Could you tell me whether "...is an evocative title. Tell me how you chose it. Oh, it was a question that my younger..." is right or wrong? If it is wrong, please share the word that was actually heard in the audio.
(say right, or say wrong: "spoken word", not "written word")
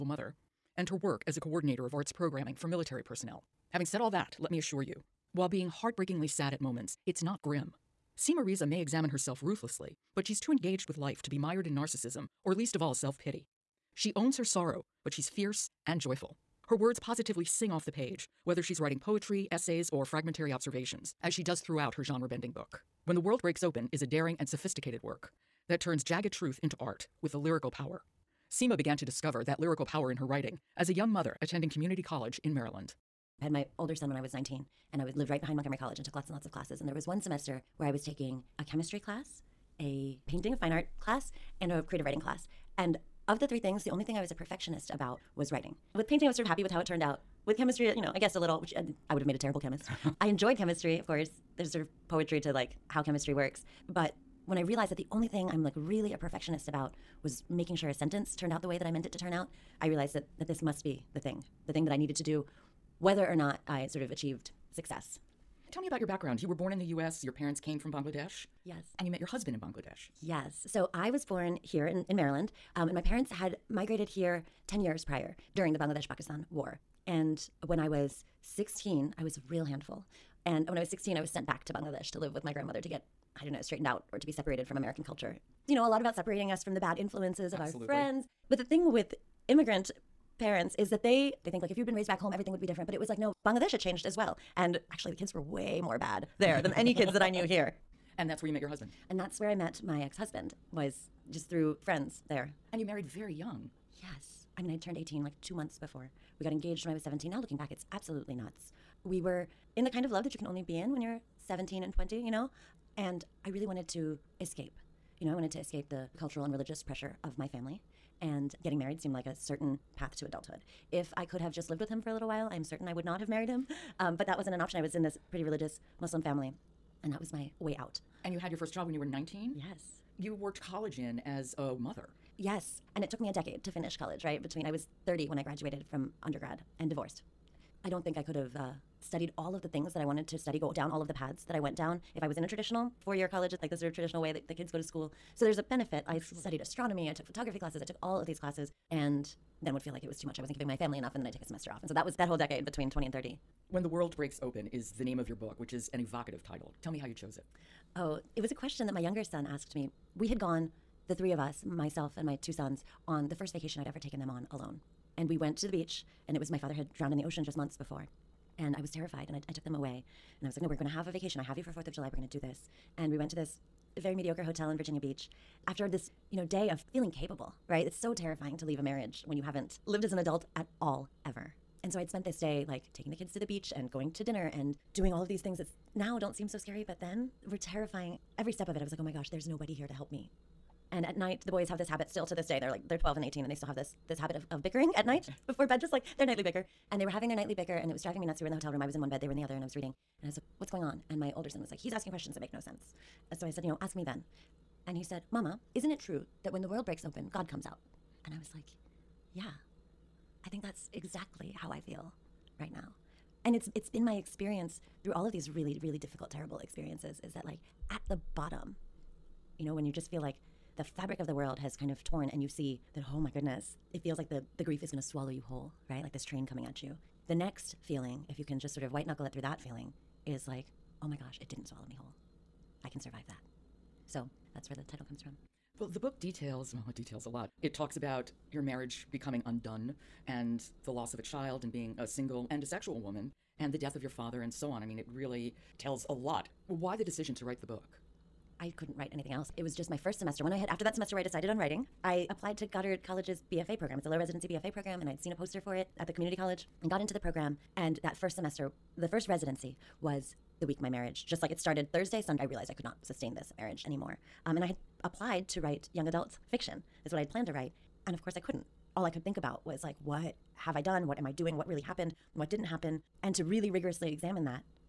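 right.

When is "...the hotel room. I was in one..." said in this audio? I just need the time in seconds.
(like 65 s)
198 s.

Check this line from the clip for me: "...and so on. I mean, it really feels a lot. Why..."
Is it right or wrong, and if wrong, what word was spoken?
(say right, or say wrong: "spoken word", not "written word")
wrong: "tells", not "feels".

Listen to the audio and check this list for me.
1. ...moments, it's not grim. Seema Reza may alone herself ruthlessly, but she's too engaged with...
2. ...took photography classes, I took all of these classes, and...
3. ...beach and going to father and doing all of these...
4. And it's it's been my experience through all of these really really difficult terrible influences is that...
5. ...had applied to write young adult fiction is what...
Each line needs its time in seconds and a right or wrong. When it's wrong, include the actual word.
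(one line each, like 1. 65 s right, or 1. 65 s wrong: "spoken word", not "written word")
1. 6 s wrong: "examine", not "alone"
2. 147 s right
3. 183 s wrong: "dinner", not "father"
4. 213 s wrong: "experiences", not "influences"
5. 264 s right.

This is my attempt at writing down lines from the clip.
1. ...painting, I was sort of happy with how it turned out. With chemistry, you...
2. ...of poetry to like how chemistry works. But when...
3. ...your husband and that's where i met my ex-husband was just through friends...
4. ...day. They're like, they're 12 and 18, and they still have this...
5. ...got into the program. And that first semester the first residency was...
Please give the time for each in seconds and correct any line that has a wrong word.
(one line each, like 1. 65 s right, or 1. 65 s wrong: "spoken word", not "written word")
1. 46 s right
2. 51 s right
3. 98 s right
4. 192 s right
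5. 256 s right.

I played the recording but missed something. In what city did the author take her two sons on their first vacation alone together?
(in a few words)
Virginia Beach.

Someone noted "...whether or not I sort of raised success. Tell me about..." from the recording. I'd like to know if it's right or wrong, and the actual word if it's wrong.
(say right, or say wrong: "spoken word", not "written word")
wrong: "achieved", not "raised".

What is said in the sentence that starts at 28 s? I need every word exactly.
Seema began to discover that lyrical power in her writing as a young mother attending community college in Maryland.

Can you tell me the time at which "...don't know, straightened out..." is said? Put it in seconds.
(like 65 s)
83 s.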